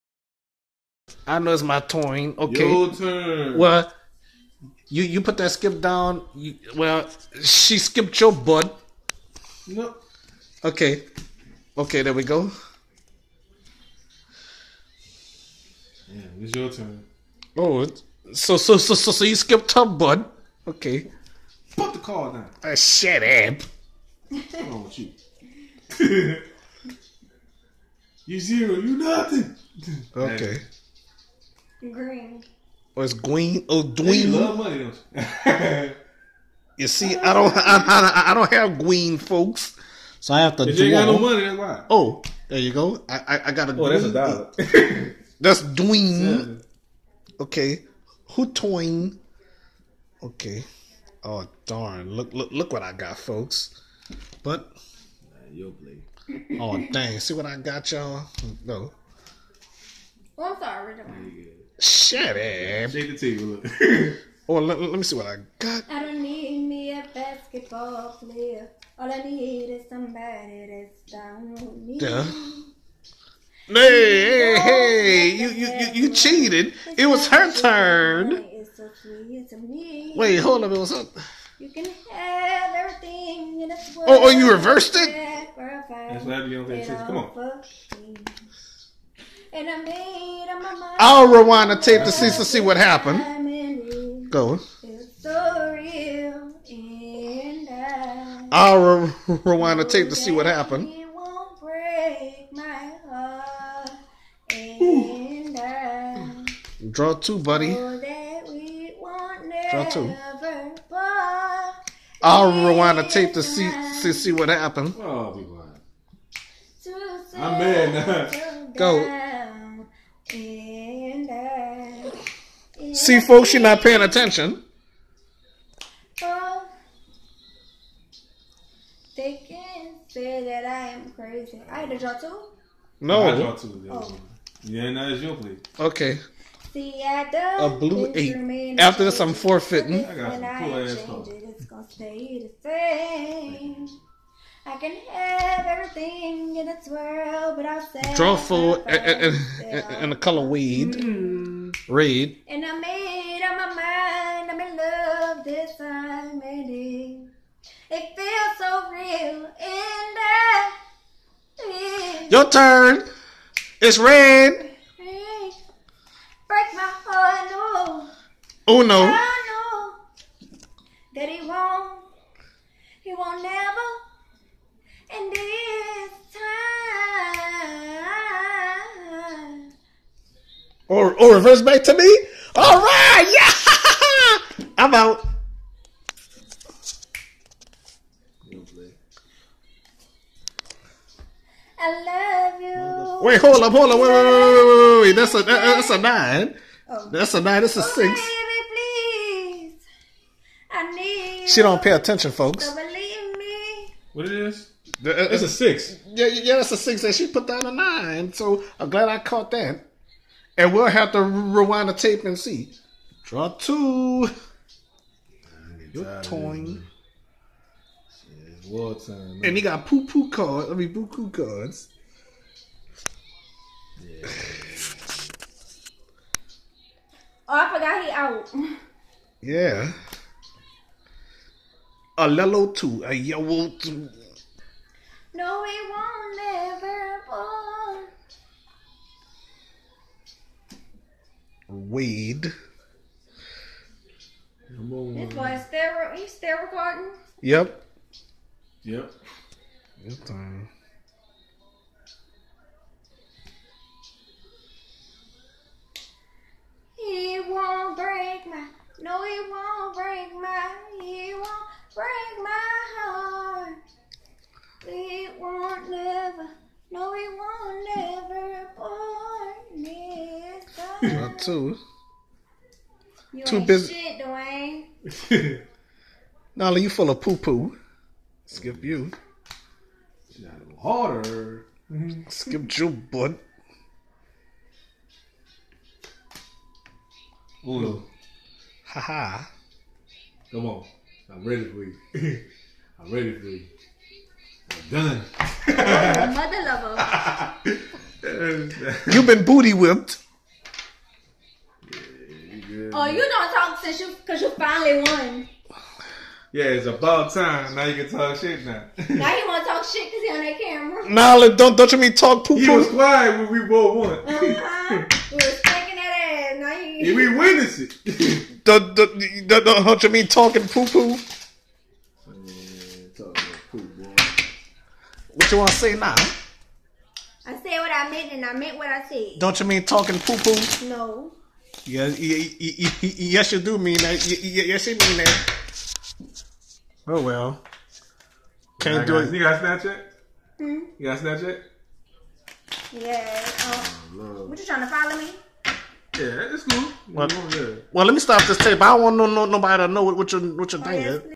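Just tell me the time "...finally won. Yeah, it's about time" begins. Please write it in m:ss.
5:04.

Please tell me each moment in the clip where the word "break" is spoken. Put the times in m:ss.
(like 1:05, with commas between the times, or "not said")
2:46, 4:22.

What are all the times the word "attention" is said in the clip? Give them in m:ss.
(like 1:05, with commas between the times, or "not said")
2:04, 3:21.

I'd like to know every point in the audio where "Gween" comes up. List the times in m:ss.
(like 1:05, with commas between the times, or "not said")
0:33, 0:38.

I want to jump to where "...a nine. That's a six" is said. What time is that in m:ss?
3:17.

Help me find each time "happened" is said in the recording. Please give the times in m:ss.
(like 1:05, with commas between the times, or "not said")
1:25, 1:32, 1:40, 1:54.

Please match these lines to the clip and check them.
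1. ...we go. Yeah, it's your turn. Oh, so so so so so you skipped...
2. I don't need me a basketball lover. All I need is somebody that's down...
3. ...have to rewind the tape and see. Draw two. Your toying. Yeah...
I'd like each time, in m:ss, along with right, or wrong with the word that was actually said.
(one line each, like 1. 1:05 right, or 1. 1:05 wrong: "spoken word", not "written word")
1. 0:12 right
2. 1:05 wrong: "player", not "lover"
3. 3:30 right.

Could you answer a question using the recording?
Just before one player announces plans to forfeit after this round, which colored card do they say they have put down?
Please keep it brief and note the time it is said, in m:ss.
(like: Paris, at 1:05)
blue 8, at 2:17.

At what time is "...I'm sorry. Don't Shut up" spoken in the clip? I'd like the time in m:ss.
1:00.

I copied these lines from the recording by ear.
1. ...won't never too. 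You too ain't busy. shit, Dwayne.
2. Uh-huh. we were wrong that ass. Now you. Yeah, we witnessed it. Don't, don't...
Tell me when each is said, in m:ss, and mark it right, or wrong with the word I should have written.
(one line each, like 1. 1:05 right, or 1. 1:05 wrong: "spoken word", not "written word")
1. 4:27 right
2. 5:14 wrong: "taking", not "wrong".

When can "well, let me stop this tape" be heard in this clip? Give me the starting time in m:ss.
5:47.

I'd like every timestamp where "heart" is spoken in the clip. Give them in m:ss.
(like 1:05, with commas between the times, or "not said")
2:47, 4:22.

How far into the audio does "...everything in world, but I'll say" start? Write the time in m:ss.
2:25.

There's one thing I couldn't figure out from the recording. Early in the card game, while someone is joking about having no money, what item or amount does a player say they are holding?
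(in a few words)
a dollar.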